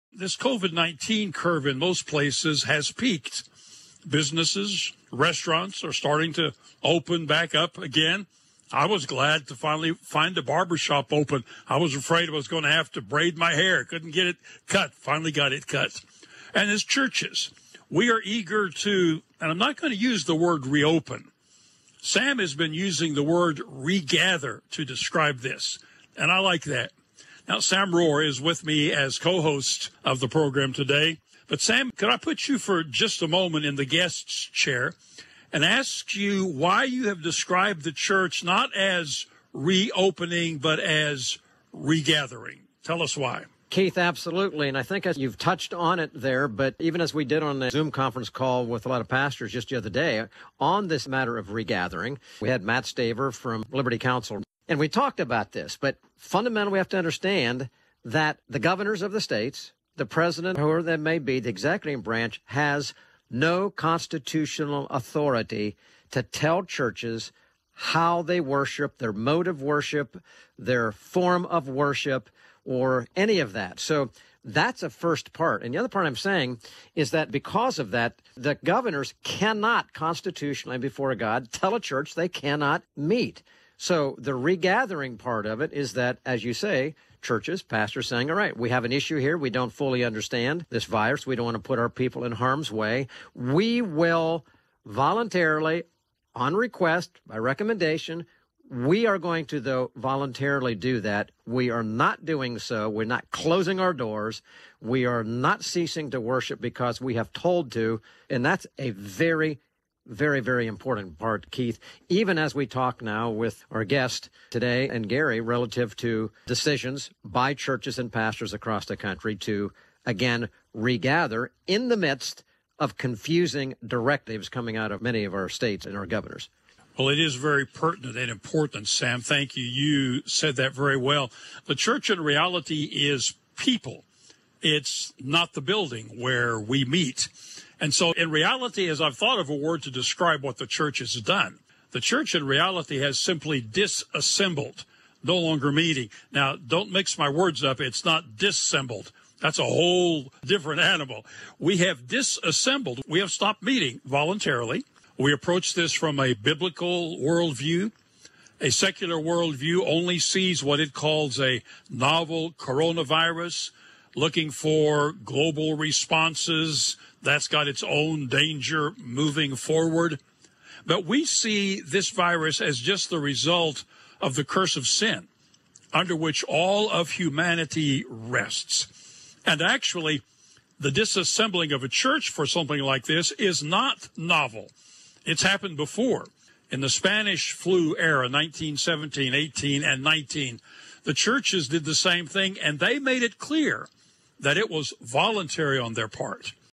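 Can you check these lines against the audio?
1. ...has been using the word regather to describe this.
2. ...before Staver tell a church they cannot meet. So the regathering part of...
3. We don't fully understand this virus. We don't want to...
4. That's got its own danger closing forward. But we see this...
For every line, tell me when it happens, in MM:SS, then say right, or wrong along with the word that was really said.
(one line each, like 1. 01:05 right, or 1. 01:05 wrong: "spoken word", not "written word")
1. 00:22 right
2. 01:20 wrong: "God", not "Staver"
3. 01:29 right
4. 02:47 wrong: "moving", not "closing".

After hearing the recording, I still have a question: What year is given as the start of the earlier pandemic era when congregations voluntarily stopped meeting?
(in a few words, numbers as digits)
1917.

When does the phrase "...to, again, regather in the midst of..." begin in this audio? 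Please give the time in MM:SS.
01:59.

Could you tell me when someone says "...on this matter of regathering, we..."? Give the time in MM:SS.
00:50.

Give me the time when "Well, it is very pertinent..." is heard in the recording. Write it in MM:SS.
02:06.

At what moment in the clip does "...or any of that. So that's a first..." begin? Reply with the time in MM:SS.
01:12.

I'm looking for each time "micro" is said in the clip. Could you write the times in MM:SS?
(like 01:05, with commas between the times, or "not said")
not said.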